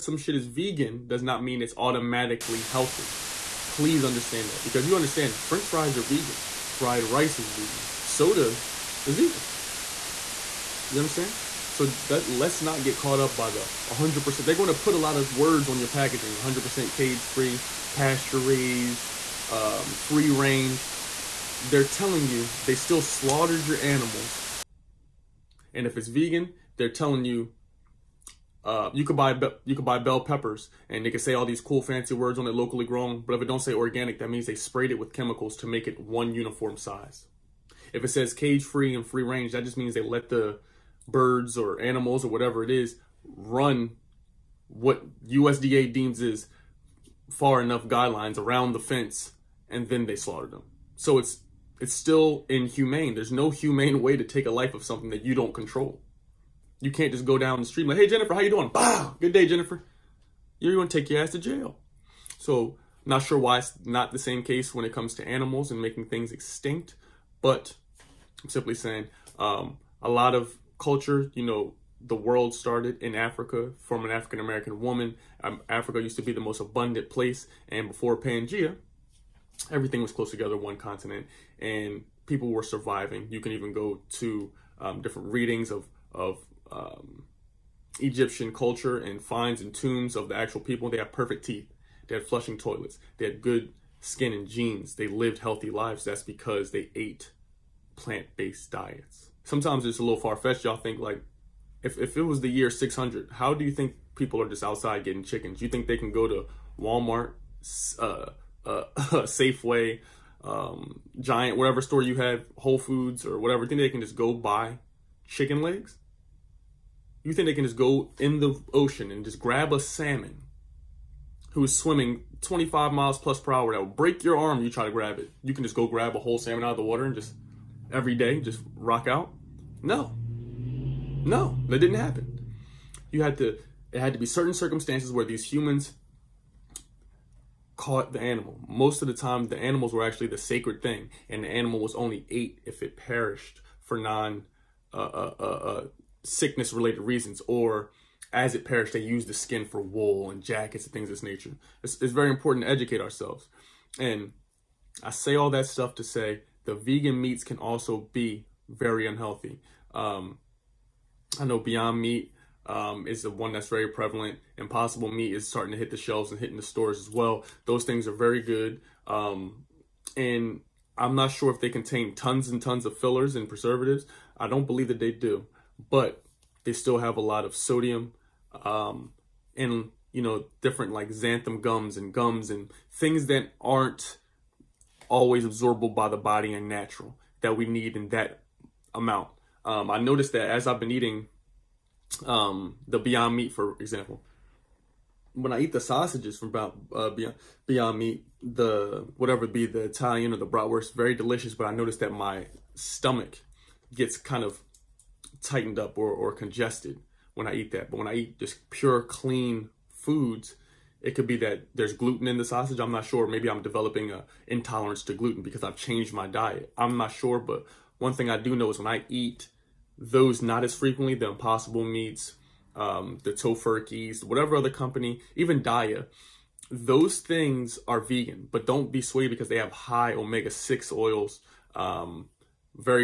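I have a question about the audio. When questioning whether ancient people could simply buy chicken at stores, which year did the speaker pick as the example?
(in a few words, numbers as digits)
600.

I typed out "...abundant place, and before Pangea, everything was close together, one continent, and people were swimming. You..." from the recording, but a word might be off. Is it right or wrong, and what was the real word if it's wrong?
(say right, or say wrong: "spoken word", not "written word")
wrong: "surviving", not "swimming".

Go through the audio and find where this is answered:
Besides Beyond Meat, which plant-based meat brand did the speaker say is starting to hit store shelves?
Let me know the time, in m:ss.
2:44.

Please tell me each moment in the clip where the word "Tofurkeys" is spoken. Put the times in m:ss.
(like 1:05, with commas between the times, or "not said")
3:43.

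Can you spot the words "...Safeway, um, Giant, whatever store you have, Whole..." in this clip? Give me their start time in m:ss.
1:49.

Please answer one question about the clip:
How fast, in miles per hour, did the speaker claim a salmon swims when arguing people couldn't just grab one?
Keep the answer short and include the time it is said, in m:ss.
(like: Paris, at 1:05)
25, at 2:02.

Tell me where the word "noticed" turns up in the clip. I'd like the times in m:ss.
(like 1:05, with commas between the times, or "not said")
3:09, 3:21.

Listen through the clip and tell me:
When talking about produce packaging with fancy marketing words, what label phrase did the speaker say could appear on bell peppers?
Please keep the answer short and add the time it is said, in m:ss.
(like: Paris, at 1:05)
locally grown, at 0:32.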